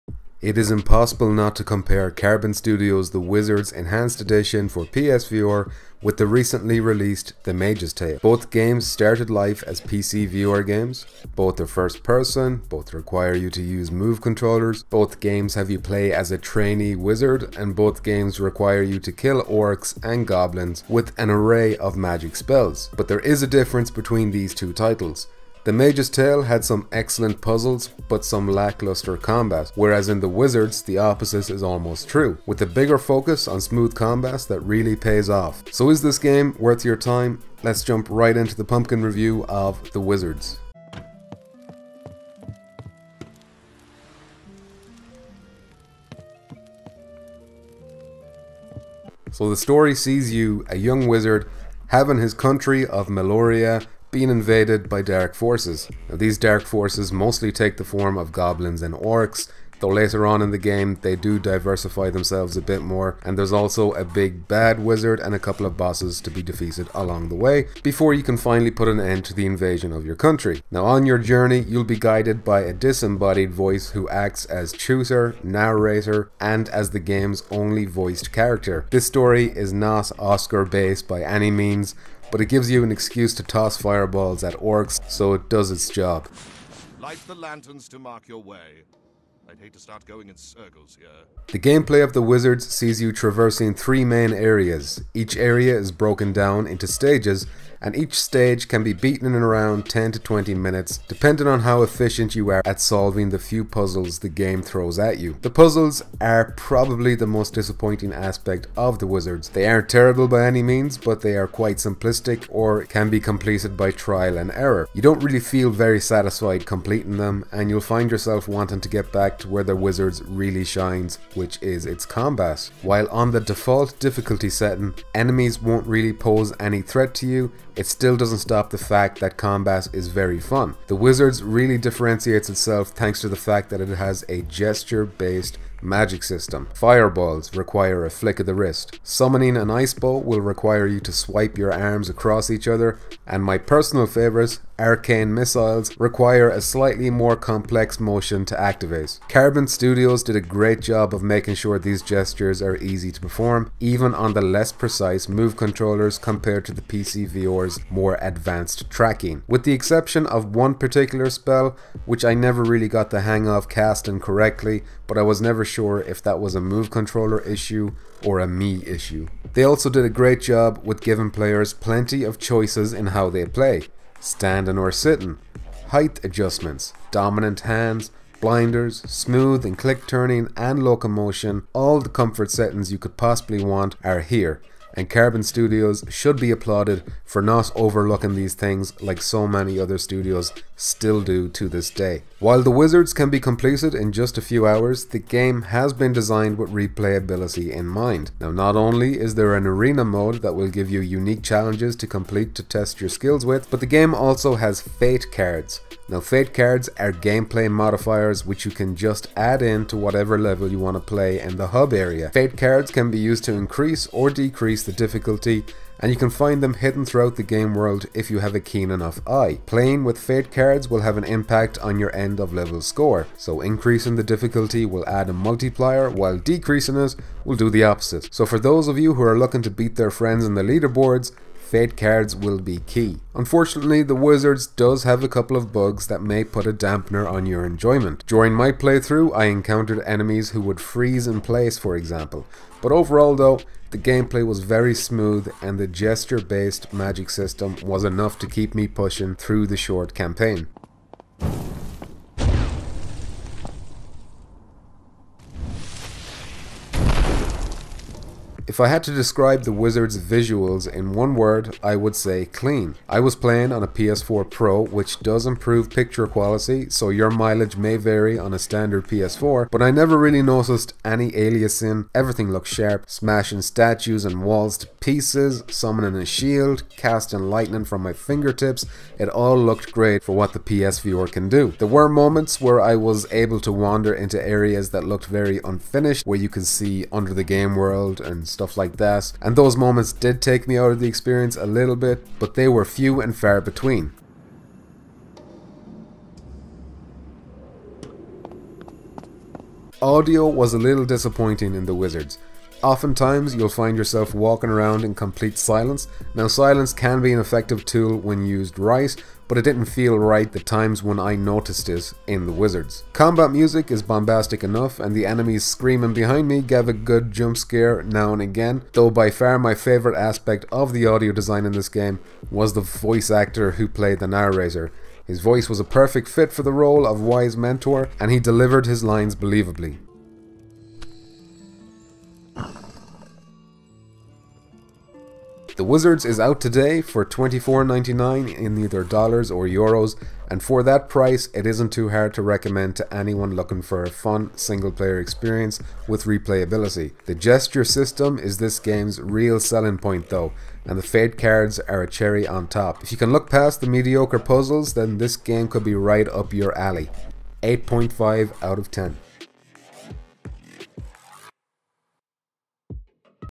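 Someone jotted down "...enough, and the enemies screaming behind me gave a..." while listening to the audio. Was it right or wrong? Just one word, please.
right.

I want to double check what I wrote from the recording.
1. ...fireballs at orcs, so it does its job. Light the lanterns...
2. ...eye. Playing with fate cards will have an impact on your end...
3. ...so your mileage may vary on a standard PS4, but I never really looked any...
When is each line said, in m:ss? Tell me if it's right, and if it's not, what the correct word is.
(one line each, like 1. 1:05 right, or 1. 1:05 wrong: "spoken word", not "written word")
1. 1:23 right
2. 3:39 right
3. 4:26 wrong: "noticed", not "looked".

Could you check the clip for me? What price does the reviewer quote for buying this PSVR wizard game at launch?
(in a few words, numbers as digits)
$24.99.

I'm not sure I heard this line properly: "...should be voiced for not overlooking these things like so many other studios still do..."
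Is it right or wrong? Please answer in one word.
wrong.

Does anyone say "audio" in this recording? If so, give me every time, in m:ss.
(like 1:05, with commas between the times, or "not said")
5:00, 5:21.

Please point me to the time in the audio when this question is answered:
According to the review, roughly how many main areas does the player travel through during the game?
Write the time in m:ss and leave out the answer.
1:33.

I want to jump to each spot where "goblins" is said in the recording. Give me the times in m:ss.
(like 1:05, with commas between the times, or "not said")
0:20, 0:58.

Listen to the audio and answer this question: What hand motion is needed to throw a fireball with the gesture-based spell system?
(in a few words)
a flick of the wrist.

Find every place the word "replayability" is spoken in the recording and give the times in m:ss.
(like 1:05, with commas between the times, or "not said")
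3:16, 5:46.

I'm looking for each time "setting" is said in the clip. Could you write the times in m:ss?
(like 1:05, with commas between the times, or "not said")
2:04, 3:02.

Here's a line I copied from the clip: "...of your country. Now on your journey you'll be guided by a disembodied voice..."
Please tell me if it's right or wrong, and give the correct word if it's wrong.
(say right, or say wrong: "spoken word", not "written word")
right.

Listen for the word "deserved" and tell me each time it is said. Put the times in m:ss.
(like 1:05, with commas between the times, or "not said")
not said.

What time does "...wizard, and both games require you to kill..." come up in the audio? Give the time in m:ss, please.
0:16.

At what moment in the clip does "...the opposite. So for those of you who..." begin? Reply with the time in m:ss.
3:47.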